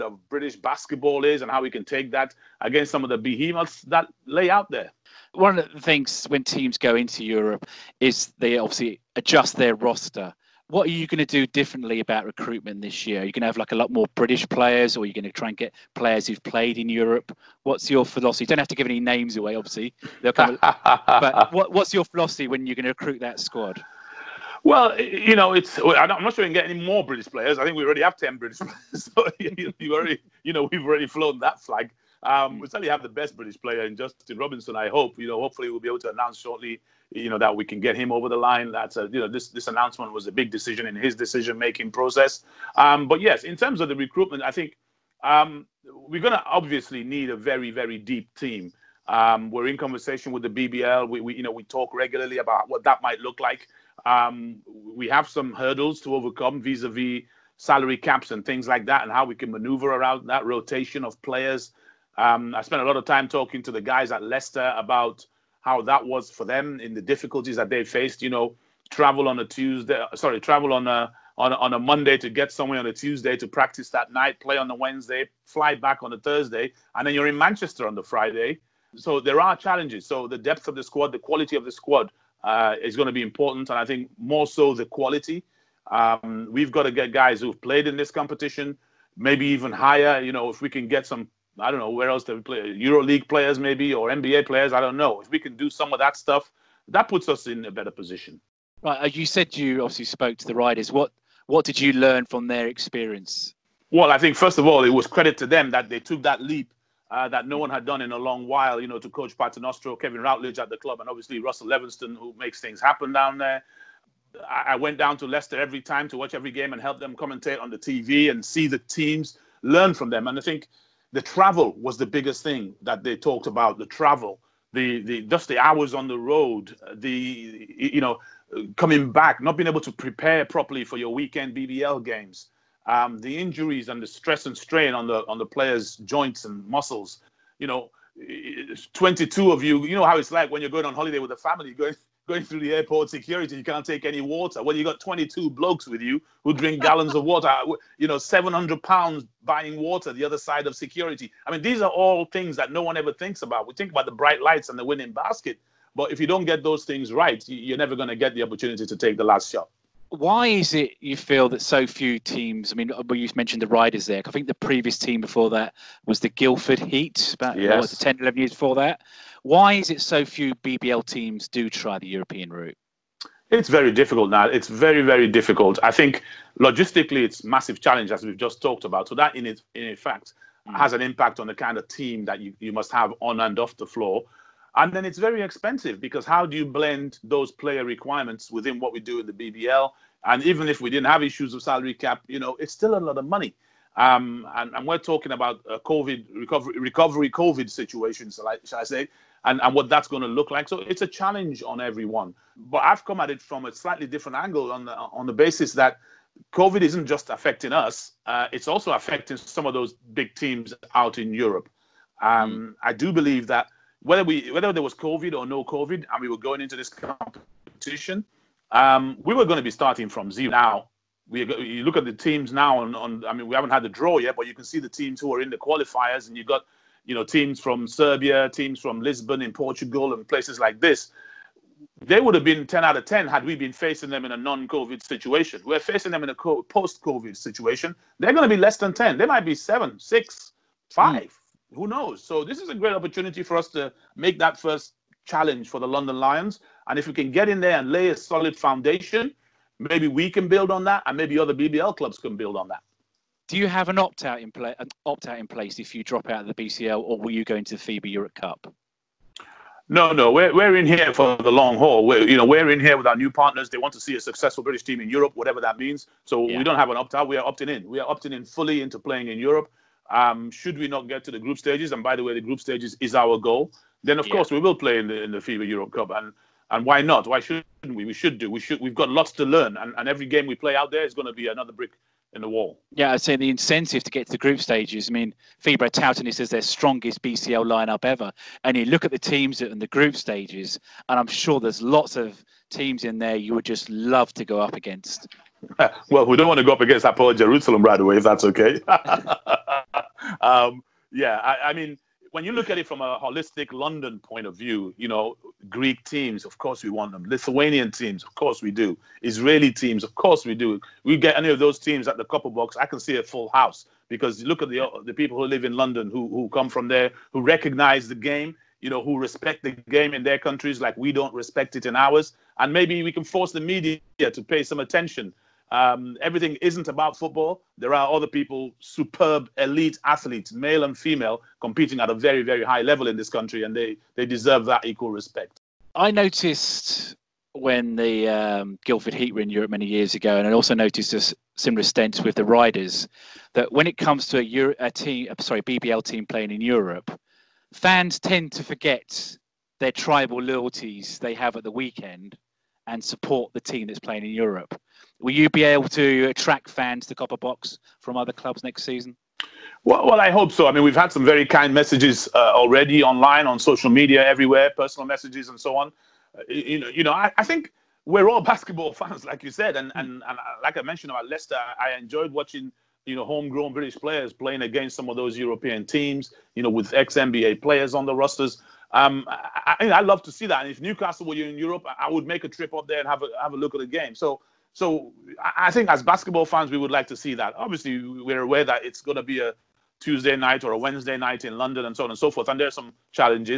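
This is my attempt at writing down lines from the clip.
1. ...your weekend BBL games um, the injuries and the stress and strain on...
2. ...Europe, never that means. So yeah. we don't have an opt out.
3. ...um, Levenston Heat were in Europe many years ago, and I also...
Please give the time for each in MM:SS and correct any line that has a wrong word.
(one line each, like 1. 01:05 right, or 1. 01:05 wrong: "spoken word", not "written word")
1. 02:10 right
2. 04:25 wrong: "whatever", not "never"
3. 05:38 wrong: "Guildford", not "Levenston".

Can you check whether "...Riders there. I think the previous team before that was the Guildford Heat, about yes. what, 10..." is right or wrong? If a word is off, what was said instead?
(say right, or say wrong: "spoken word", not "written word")
right.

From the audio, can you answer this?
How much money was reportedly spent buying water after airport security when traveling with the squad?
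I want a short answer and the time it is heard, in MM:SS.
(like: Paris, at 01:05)
700 pounds, at 02:28.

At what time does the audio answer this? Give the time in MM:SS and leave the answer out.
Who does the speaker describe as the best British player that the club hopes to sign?
00:33.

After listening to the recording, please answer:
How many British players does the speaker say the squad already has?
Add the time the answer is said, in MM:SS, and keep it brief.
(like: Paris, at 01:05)
10, at 00:28.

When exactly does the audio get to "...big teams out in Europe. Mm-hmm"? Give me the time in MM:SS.
03:30.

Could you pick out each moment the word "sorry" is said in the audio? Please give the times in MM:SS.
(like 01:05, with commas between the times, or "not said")
01:10, 05:45.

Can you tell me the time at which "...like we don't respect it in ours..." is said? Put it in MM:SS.
05:20.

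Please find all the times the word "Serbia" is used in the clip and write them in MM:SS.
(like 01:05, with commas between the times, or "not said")
03:47.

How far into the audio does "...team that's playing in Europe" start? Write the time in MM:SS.
05:53.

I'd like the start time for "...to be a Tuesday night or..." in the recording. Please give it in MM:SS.
06:29.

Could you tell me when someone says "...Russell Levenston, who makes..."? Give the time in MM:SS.
01:51.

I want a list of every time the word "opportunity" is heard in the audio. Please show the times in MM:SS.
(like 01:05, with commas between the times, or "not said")
02:38, 04:02.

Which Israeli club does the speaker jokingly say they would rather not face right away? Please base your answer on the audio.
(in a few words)
Hapoel Jerusalem.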